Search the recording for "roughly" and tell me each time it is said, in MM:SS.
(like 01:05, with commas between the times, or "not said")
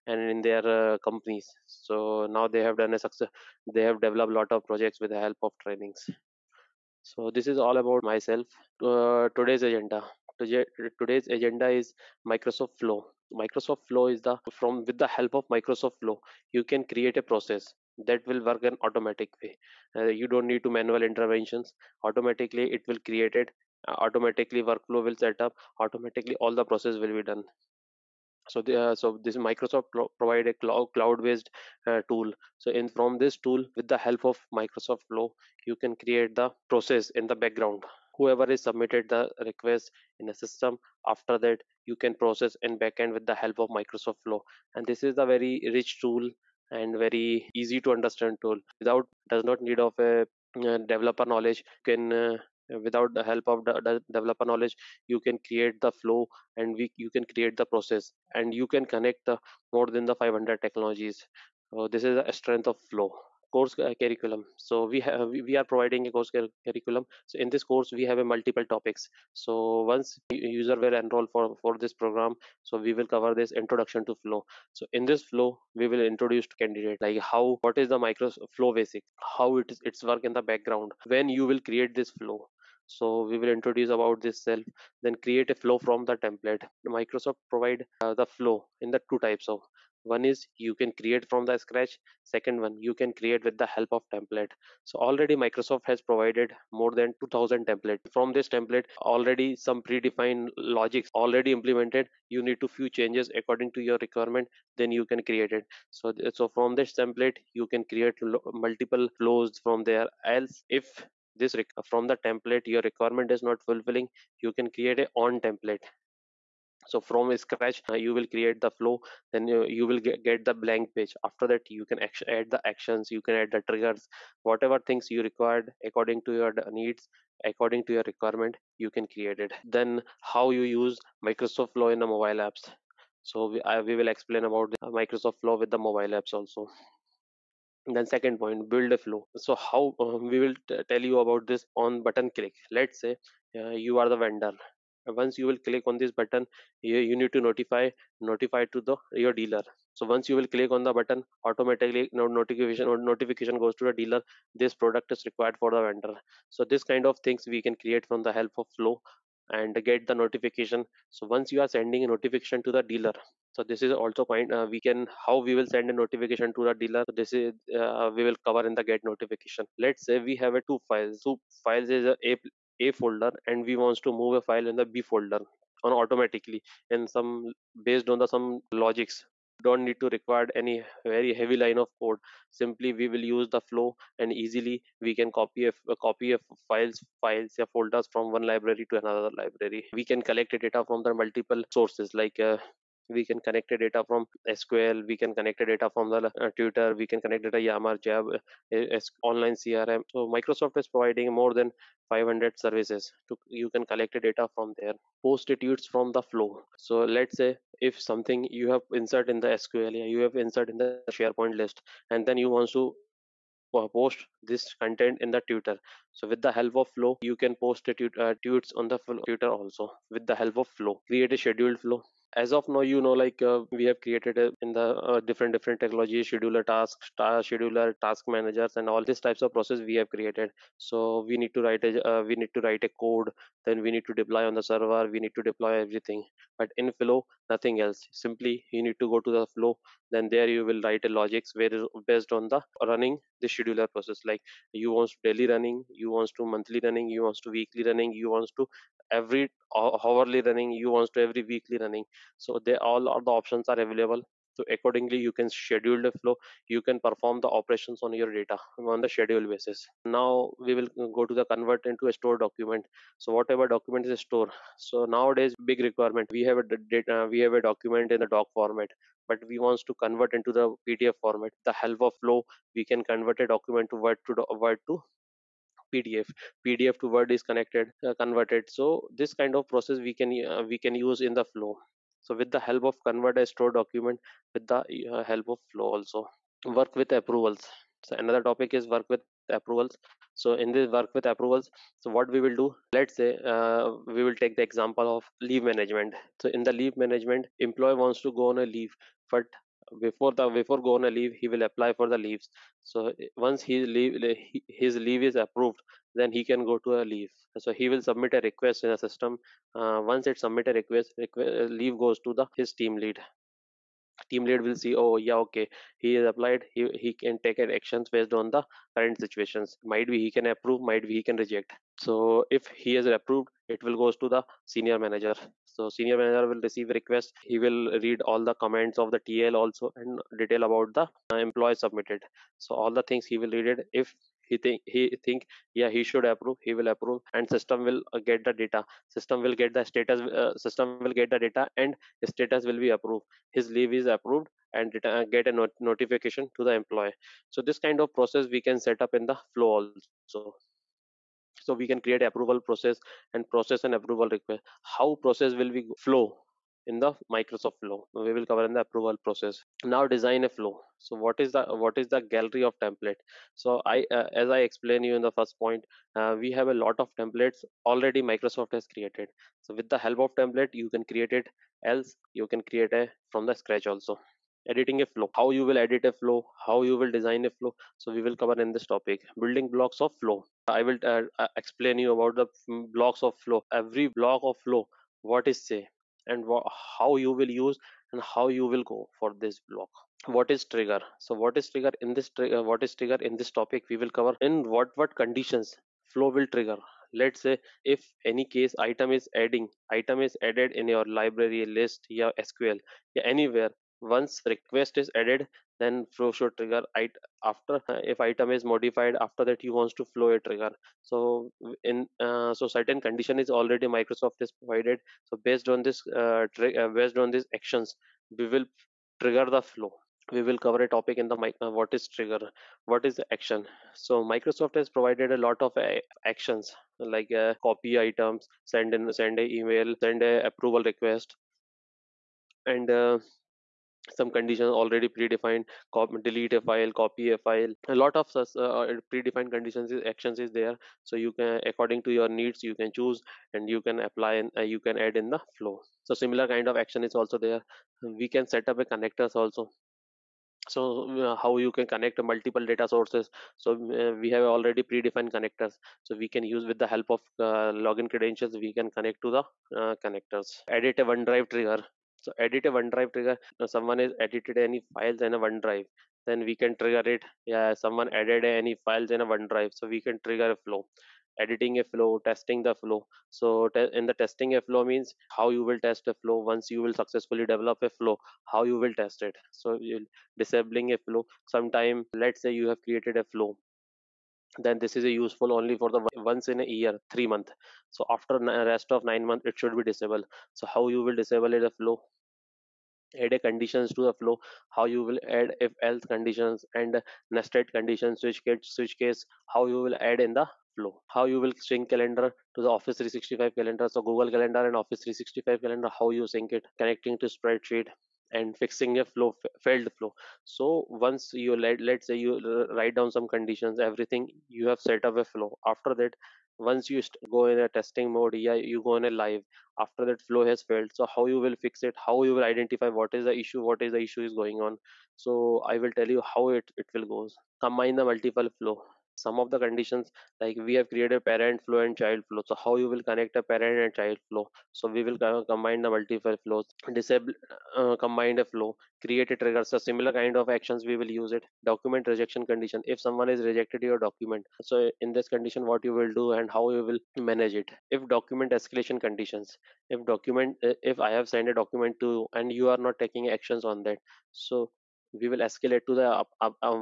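not said.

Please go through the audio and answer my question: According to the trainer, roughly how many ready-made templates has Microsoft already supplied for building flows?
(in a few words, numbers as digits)
2000.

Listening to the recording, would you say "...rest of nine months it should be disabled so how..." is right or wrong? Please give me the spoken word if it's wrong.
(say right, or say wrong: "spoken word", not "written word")
right.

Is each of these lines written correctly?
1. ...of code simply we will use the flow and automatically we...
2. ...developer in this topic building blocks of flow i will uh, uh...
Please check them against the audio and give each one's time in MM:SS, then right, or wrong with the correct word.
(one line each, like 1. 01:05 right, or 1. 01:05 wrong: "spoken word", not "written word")
1. 03:01 wrong: "easily", not "automatically"
2. 06:18 wrong: "cover", not "developer".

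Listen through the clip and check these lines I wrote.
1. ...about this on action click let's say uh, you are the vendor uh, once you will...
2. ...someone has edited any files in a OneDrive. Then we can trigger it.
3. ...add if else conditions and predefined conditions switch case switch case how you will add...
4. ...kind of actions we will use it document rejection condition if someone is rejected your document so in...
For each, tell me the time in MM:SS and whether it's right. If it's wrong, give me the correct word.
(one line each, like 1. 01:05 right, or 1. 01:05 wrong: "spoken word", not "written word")
1. 02:21 wrong: "button", not "action"
2. 07:43 right
3. 08:15 wrong: "nested", not "predefined"
4. 09:00 right.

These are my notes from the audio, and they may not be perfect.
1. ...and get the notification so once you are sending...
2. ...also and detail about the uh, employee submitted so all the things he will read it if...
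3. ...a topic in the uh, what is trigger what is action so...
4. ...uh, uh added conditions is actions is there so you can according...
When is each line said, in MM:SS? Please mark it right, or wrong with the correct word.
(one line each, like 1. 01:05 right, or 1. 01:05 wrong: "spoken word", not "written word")
1. 02:39 right
2. 05:29 right
3. 07:00 right
4. 07:18 wrong: "predefined", not "added".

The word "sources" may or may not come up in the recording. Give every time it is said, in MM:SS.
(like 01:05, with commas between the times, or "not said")
03:11, 07:32.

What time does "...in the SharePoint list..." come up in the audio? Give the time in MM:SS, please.
03:30.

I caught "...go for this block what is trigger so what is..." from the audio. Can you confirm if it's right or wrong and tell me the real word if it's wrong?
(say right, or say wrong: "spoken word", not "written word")
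right.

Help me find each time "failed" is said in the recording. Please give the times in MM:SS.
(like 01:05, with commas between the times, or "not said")
08:29, 08:40.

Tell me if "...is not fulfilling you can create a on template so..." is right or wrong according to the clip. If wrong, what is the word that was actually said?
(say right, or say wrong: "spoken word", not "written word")
right.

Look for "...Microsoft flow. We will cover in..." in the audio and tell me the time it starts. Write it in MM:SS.
05:57.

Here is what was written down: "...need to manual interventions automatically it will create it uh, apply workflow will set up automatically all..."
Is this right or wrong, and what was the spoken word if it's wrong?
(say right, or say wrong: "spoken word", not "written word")
wrong: "automatically", not "apply".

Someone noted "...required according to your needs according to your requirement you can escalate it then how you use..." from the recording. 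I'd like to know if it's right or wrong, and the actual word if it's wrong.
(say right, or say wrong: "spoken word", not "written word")
wrong: "create", not "escalate".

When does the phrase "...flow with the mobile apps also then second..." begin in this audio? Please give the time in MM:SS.
02:15.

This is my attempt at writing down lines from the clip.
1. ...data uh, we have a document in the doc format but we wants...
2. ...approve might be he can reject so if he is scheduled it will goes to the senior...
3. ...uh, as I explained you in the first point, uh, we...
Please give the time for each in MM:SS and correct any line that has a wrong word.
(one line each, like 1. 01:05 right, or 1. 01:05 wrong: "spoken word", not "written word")
1. 04:26 right
2. 05:20 wrong: "approved", not "scheduled"
3. 06:04 right.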